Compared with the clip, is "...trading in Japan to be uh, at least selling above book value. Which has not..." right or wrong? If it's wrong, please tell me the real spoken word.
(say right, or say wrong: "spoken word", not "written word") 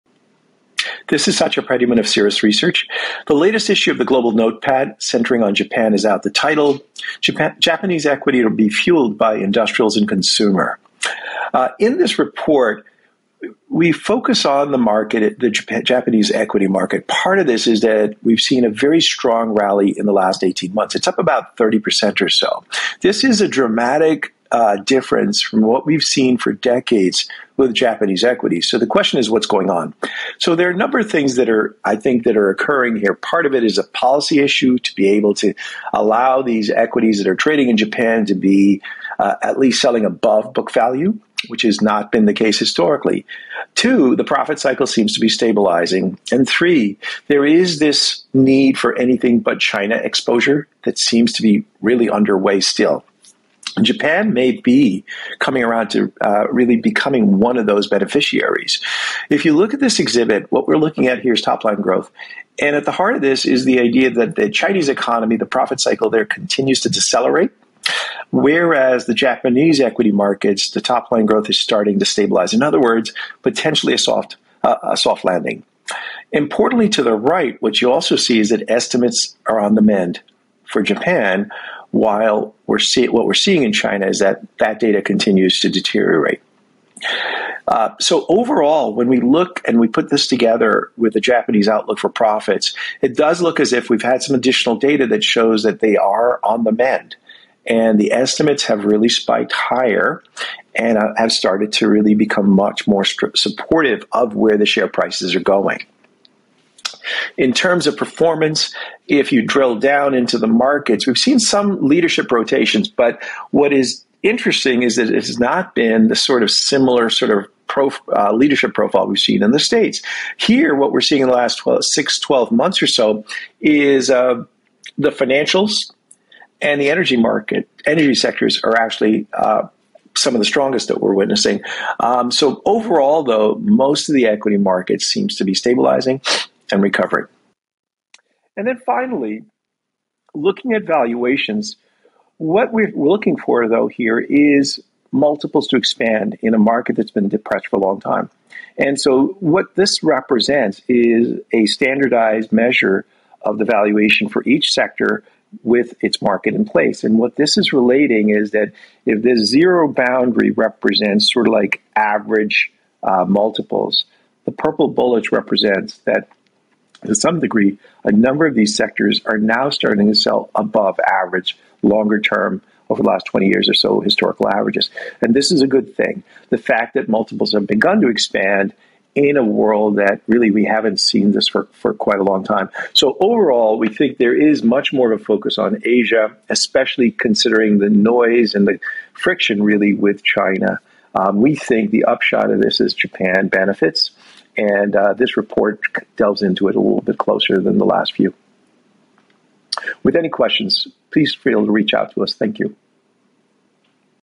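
right.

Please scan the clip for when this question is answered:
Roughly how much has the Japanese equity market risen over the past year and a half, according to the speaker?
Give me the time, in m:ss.
0:21.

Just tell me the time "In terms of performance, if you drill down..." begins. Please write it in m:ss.
1:47.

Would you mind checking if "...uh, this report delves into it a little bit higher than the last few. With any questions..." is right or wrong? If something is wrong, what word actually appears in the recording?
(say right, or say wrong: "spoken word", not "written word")
wrong: "closer", not "higher".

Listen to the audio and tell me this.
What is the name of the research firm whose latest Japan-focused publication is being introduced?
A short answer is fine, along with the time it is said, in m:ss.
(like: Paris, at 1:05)
Cirrus Research, at 0:02.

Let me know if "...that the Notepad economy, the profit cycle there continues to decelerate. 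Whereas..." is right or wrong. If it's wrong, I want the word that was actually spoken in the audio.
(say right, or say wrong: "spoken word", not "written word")
wrong: "Chinese", not "Notepad".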